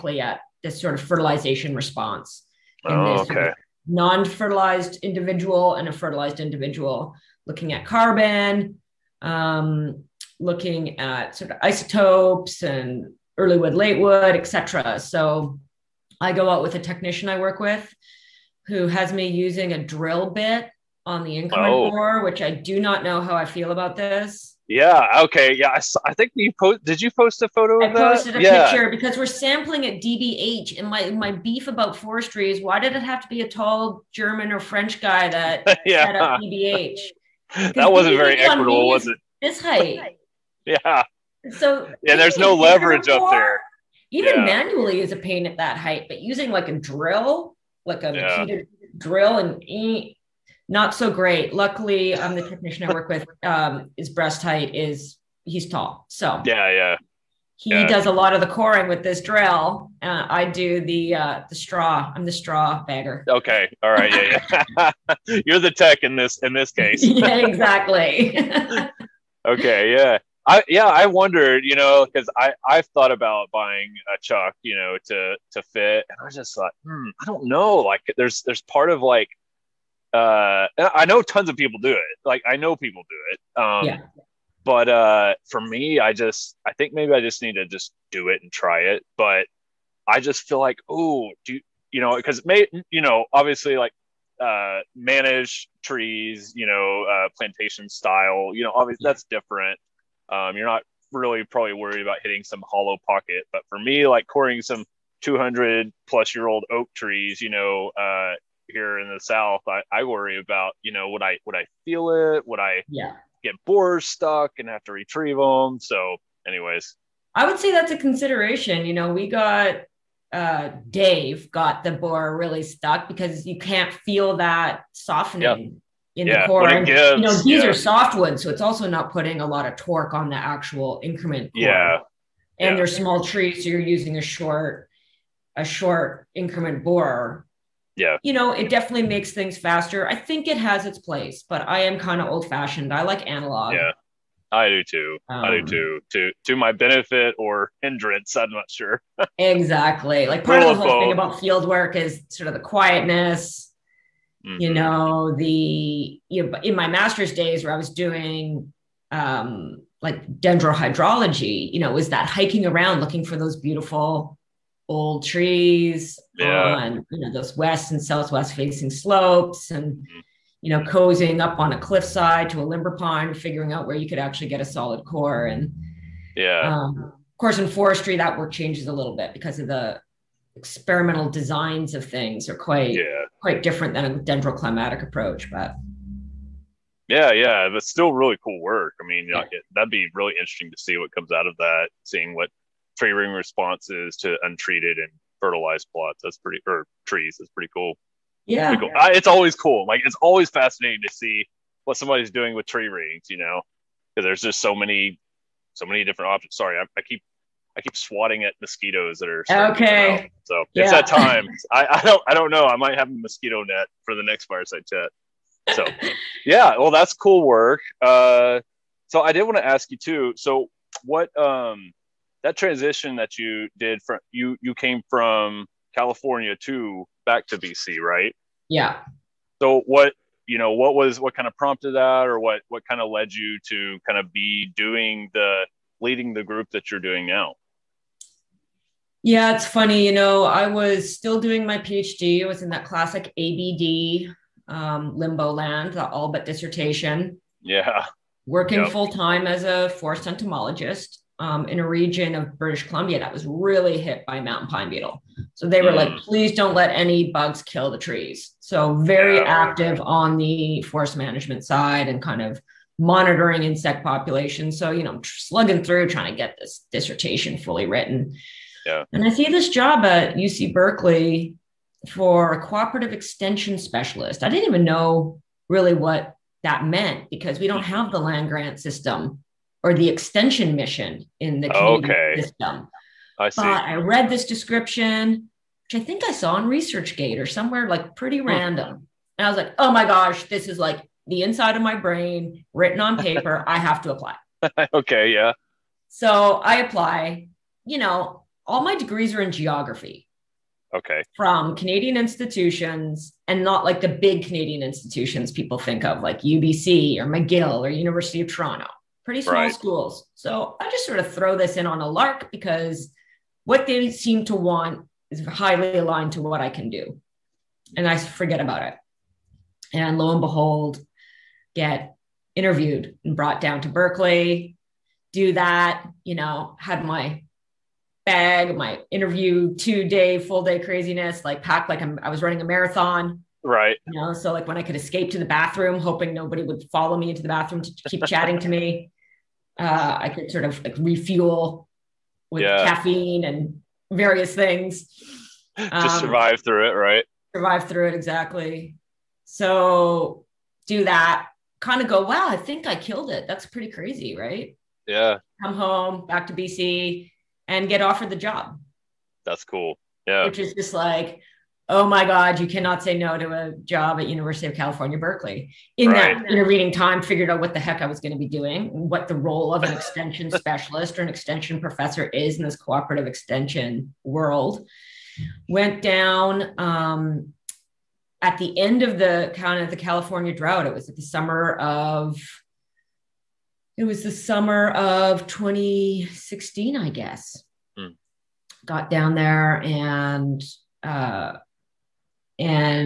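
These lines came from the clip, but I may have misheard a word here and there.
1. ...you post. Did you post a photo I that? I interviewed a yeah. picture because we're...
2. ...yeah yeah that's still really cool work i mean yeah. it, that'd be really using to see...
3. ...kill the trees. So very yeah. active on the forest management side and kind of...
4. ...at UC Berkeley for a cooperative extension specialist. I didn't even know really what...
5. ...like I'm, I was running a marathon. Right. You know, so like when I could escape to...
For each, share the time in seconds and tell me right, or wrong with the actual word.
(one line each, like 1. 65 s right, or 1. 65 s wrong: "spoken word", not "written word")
1. 26 s wrong: "posted", not "interviewed"
2. 187 s wrong: "interesting", not "using"
3. 257 s right
4. 270 s right
5. 331 s right.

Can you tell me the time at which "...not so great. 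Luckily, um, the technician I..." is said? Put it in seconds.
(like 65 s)
50 s.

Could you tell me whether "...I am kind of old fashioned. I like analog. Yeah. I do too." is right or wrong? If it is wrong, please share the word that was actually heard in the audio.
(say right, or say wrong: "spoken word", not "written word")
right.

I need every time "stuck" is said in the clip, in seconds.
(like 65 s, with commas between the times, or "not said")
114 s, 122 s.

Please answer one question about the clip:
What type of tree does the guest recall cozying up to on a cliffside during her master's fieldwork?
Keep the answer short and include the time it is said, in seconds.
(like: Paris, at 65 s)
Limber pine, at 172 s.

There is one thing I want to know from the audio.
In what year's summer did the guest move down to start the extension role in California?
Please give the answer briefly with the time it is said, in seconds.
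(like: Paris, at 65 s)
2016, at 385 s.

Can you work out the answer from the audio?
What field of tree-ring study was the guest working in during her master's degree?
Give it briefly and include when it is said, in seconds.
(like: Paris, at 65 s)
Dendrohydrology, at 160 s.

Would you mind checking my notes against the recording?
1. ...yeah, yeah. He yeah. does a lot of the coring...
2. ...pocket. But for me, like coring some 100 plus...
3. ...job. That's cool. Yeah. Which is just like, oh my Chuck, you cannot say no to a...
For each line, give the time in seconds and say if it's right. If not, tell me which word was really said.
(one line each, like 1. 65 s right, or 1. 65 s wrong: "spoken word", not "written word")
1. 56 s right
2. 103 s wrong: "200", not "100"
3. 358 s wrong: "God", not "Chuck".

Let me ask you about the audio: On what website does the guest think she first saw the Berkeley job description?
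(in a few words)
ResearchGate.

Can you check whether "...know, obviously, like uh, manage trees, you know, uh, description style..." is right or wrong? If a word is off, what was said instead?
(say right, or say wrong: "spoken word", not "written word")
wrong: "plantation", not "description".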